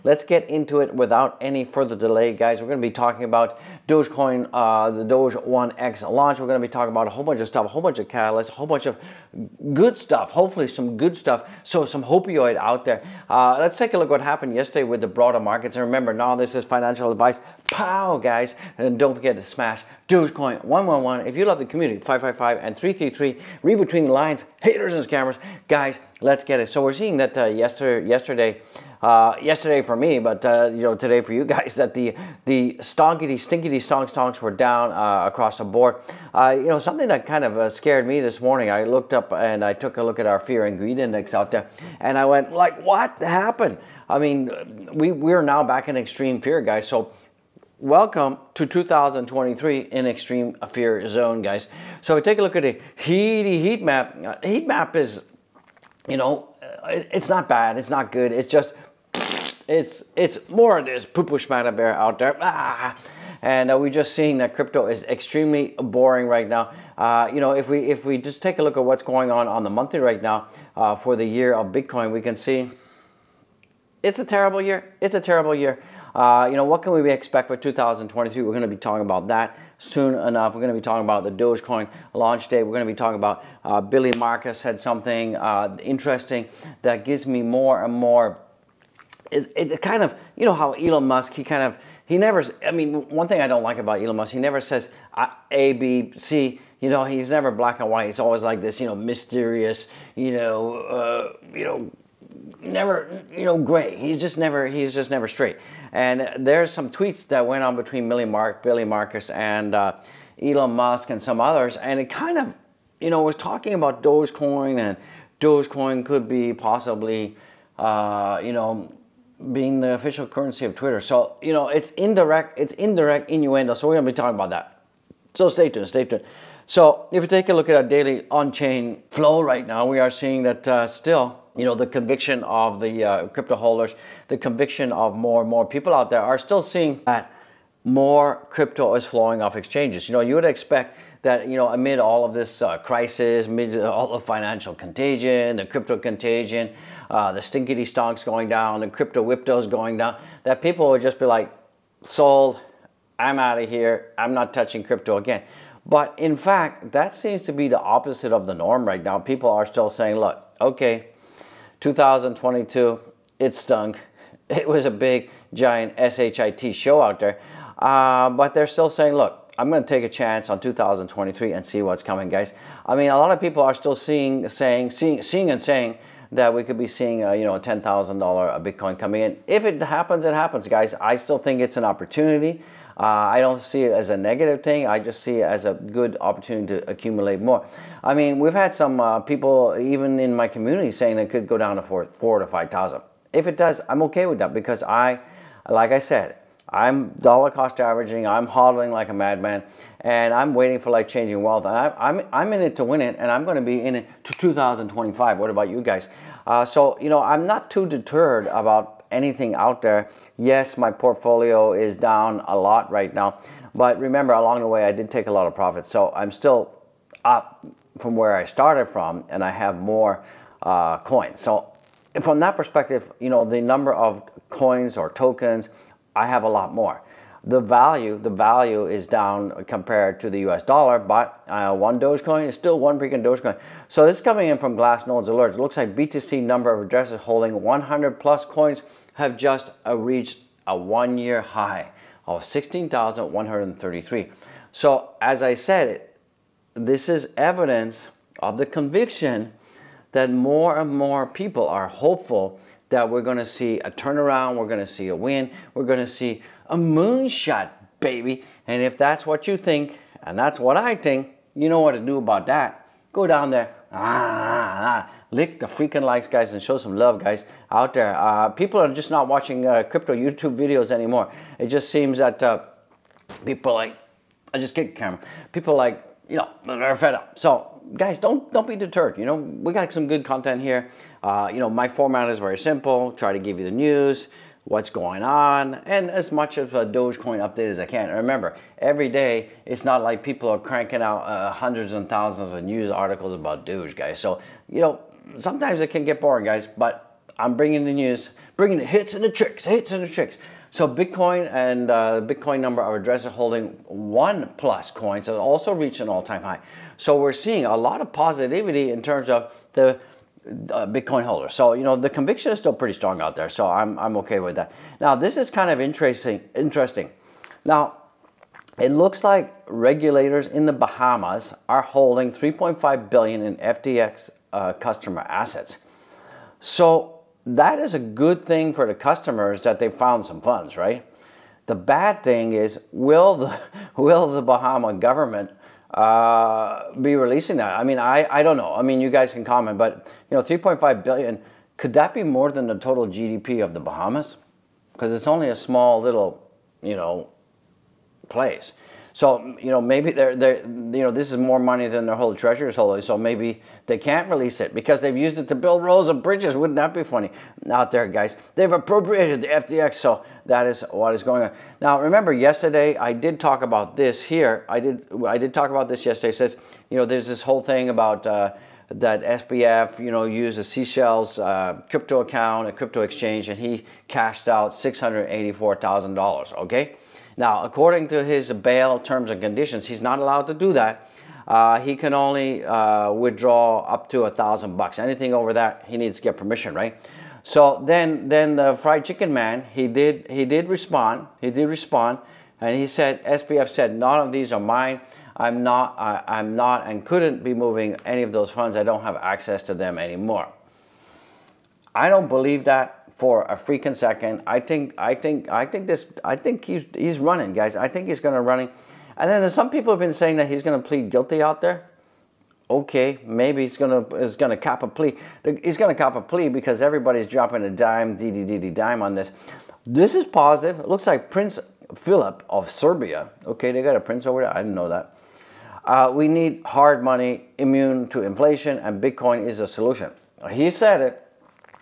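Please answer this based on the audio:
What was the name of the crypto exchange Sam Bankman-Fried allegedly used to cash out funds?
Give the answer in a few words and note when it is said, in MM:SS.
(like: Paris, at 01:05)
Seashells, at 06:10.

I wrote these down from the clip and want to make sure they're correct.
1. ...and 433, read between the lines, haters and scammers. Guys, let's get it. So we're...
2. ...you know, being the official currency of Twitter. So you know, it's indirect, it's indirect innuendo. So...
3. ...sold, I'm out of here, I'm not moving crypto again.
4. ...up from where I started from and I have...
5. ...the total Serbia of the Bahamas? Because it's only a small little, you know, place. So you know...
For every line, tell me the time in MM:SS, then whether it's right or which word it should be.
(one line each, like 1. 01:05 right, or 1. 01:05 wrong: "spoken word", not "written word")
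1. 00:22 wrong: "333", not "433"
2. 01:58 right
3. 02:32 wrong: "touching", not "moving"
4. 03:37 right
5. 05:42 wrong: "GDP", not "Serbia".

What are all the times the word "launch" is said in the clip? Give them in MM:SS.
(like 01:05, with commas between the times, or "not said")
00:06, 01:22.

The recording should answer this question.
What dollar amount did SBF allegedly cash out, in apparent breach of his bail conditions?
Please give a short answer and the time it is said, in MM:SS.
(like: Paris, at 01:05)
$684,000, at 06:14.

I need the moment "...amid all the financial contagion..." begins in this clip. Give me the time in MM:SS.
02:23.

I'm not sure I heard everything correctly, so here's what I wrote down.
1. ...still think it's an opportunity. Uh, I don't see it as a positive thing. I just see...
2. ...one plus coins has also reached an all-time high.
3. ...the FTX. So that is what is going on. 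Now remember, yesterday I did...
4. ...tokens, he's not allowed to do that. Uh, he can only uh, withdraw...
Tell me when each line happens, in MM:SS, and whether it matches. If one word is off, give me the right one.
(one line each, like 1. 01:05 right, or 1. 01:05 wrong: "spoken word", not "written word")
1. 03:01 wrong: "negative", not "positive"
2. 05:03 right
3. 05:59 right
4. 06:19 wrong: "conditions", not "tokens".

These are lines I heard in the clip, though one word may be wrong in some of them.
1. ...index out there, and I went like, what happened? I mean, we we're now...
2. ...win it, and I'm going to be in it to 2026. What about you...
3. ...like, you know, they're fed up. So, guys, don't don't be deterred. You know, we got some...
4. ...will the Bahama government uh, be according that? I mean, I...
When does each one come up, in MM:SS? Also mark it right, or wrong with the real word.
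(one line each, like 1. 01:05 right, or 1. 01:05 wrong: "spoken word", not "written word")
1. 00:40 right
2. 03:22 wrong: "2025", not "2026"
3. 04:35 right
4. 05:33 wrong: "releasing", not "according".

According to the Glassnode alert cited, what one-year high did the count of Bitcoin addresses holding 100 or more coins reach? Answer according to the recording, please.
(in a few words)
16,133.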